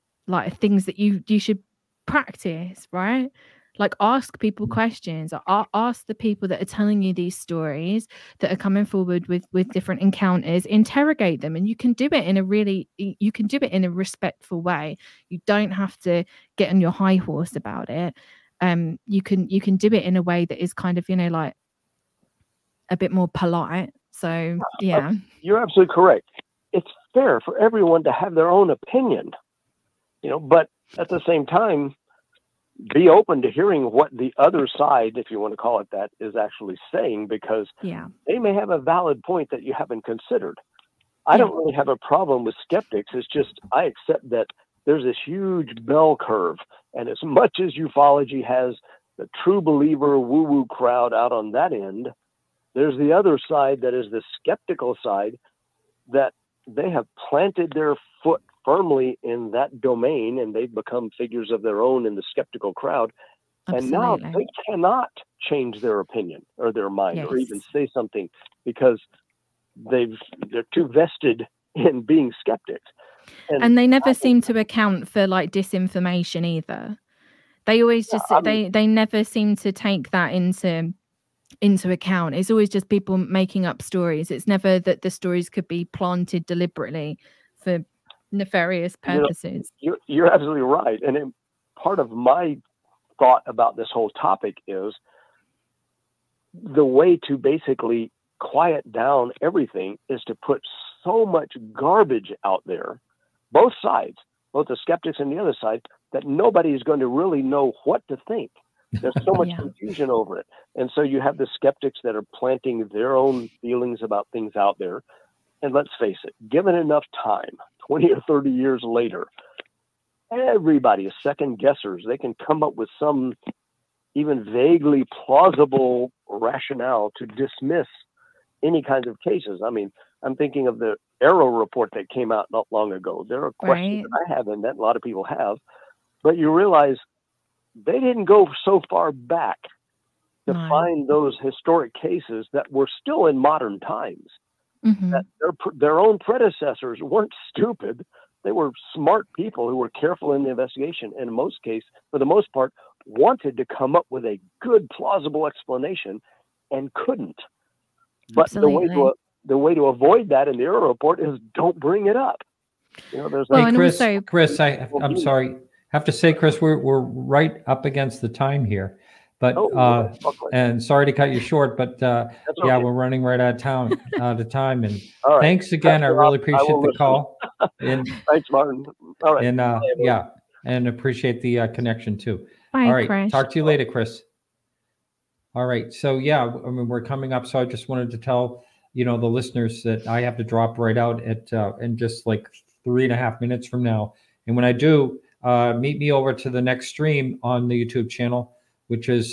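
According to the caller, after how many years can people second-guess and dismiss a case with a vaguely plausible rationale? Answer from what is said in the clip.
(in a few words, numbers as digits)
20 or 30.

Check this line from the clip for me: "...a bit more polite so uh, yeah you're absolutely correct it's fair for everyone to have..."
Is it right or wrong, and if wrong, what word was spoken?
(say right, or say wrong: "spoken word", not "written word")
right.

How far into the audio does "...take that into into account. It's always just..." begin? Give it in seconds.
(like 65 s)
79 s.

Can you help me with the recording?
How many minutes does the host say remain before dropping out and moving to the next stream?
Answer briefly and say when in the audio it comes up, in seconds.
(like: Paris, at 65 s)
3.5, at 192 s.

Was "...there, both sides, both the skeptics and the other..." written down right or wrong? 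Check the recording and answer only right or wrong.
right.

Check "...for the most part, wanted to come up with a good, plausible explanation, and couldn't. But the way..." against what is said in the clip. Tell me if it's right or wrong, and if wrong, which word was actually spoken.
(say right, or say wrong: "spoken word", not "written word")
right.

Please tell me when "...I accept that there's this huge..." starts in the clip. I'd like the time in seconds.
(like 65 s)
43 s.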